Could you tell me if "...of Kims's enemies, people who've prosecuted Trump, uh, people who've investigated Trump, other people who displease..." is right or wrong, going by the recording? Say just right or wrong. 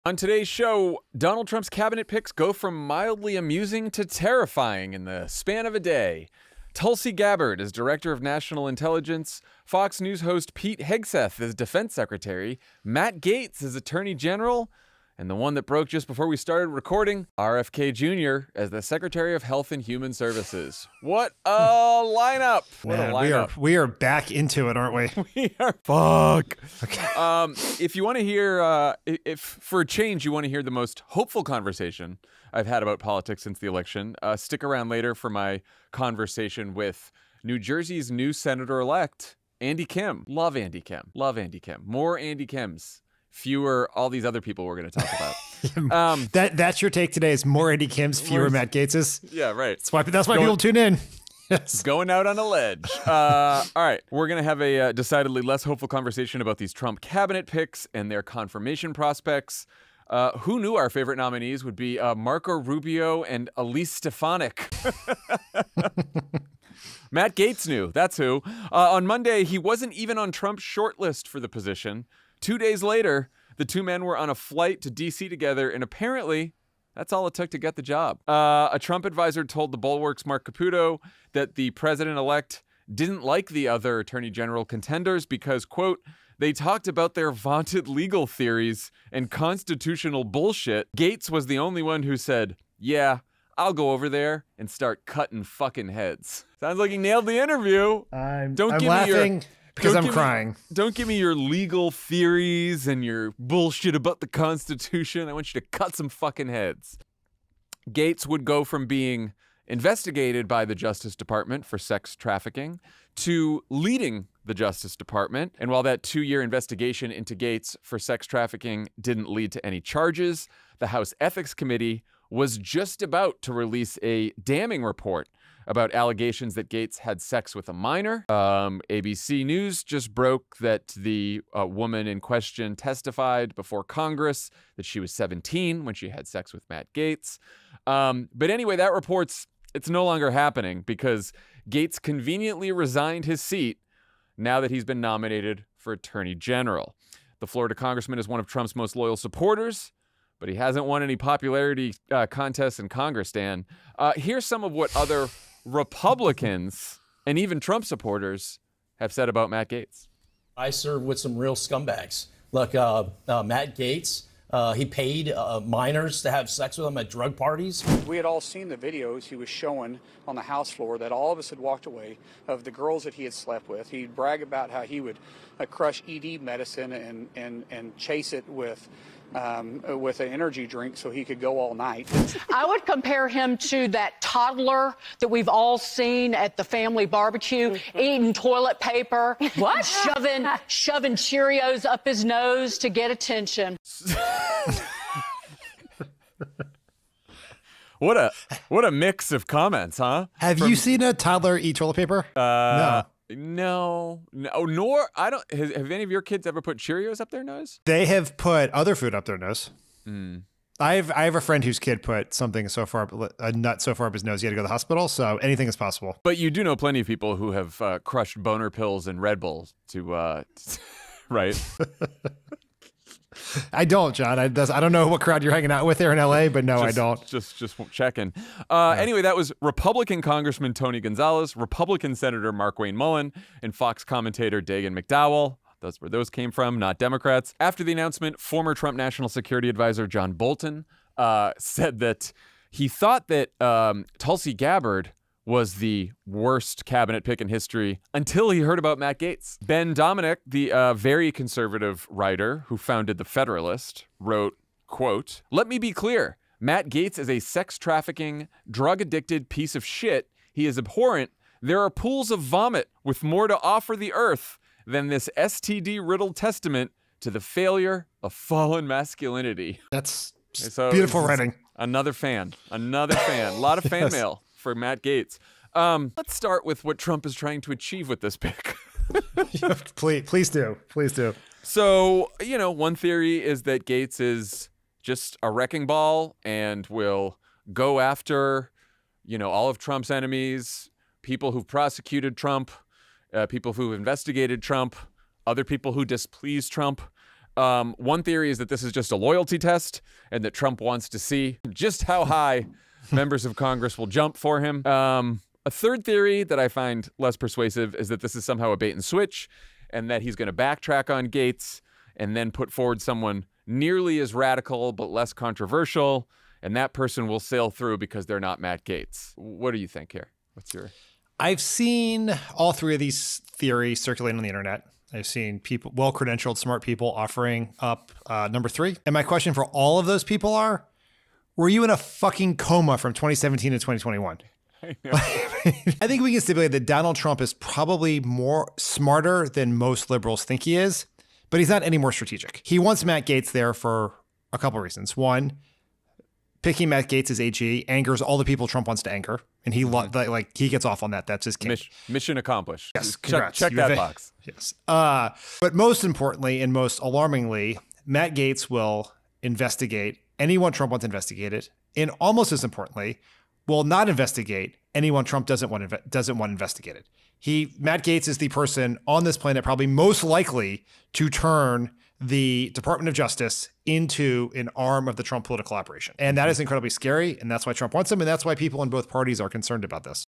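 wrong.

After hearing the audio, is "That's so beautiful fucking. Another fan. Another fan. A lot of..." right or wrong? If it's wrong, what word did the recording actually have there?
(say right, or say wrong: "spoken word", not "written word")
wrong: "writing", not "fucking".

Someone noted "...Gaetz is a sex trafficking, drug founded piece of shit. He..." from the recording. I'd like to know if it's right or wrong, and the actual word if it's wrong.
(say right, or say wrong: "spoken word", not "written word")
wrong: "addicted", not "founded".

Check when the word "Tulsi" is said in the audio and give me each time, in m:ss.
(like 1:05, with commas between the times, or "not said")
0:06, 4:04.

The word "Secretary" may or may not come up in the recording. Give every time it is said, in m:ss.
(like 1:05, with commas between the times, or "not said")
0:11, 0:18.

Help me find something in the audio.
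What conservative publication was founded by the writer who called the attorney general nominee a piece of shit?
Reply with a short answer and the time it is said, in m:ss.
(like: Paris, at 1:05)
The Federalist, at 4:13.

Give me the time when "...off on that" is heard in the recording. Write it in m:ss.
5:50.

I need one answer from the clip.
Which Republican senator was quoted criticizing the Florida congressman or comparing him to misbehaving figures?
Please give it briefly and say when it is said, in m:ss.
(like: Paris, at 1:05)
Markwayne Mullin, at 3:52.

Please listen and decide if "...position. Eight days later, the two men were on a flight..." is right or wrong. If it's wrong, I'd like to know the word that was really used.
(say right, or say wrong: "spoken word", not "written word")
wrong: "Two", not "Eight".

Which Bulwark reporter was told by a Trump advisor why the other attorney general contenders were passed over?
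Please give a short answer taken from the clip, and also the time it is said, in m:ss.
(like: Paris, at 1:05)
Marc Caputo, at 1:20.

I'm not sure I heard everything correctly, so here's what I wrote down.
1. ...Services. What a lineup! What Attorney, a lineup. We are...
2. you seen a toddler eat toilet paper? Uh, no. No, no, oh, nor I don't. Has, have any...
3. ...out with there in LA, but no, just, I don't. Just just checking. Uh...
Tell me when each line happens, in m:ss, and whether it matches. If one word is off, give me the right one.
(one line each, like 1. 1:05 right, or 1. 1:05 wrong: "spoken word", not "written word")
1. 0:20 wrong: "Man", not "Attorney"
2. 3:20 right
3. 3:45 right.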